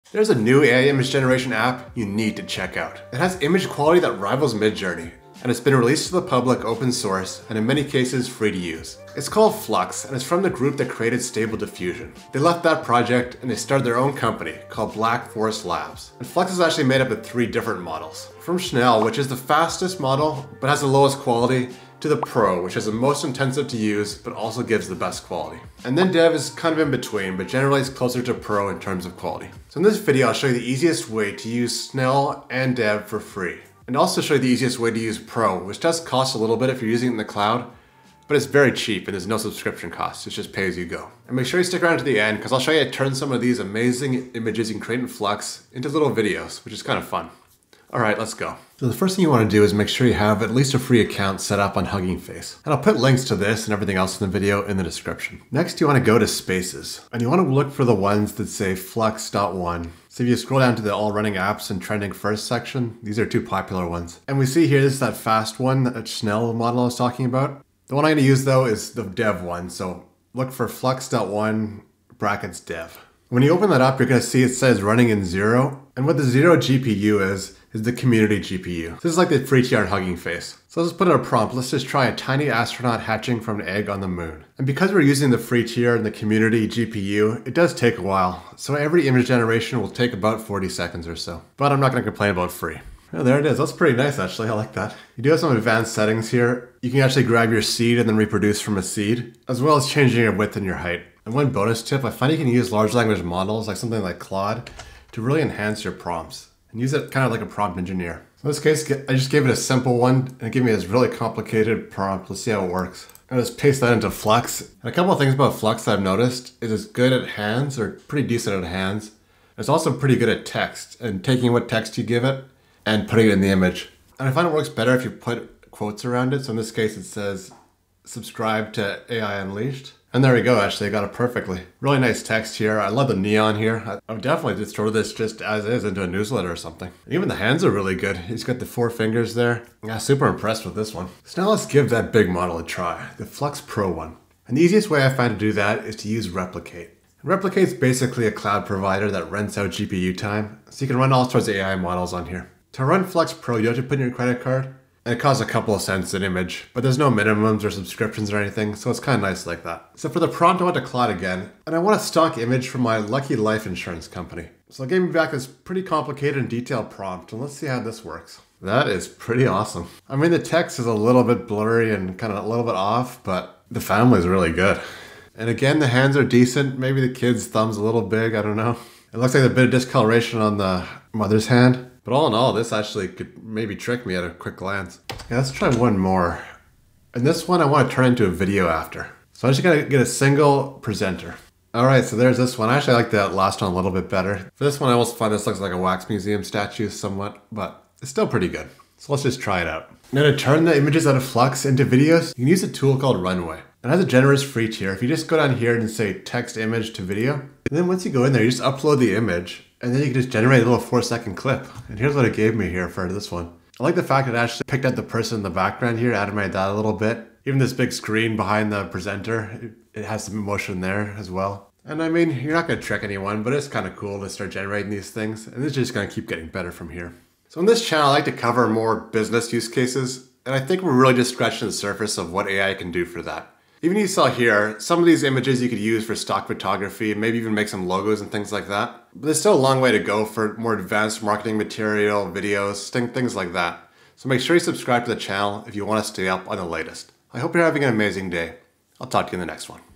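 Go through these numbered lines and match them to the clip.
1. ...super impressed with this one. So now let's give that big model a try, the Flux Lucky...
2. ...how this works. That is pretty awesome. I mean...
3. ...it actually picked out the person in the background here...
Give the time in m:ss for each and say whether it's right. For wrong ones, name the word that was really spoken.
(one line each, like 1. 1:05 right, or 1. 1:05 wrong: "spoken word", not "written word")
1. 2:19 wrong: "Pro", not "Lucky"
2. 2:47 right
3. 3:34 right.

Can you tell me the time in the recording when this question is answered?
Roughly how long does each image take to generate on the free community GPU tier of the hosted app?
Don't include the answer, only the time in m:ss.
1:30.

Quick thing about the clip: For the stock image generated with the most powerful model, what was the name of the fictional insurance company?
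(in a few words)
Lucky Life Insurance Company.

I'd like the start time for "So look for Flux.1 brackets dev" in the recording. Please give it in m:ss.
1:09.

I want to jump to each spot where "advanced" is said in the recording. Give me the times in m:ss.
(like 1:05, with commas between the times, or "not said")
1:35, 4:00.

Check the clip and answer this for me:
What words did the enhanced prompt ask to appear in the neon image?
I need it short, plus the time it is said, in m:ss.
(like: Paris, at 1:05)
subscribe to AI Unleashed, at 2:08.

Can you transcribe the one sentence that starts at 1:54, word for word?
And a couple of things about Flux I've noticed is it's good at hands or pretty decent at hands.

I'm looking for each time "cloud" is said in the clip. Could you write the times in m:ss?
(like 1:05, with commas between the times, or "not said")
0:37, 2:28.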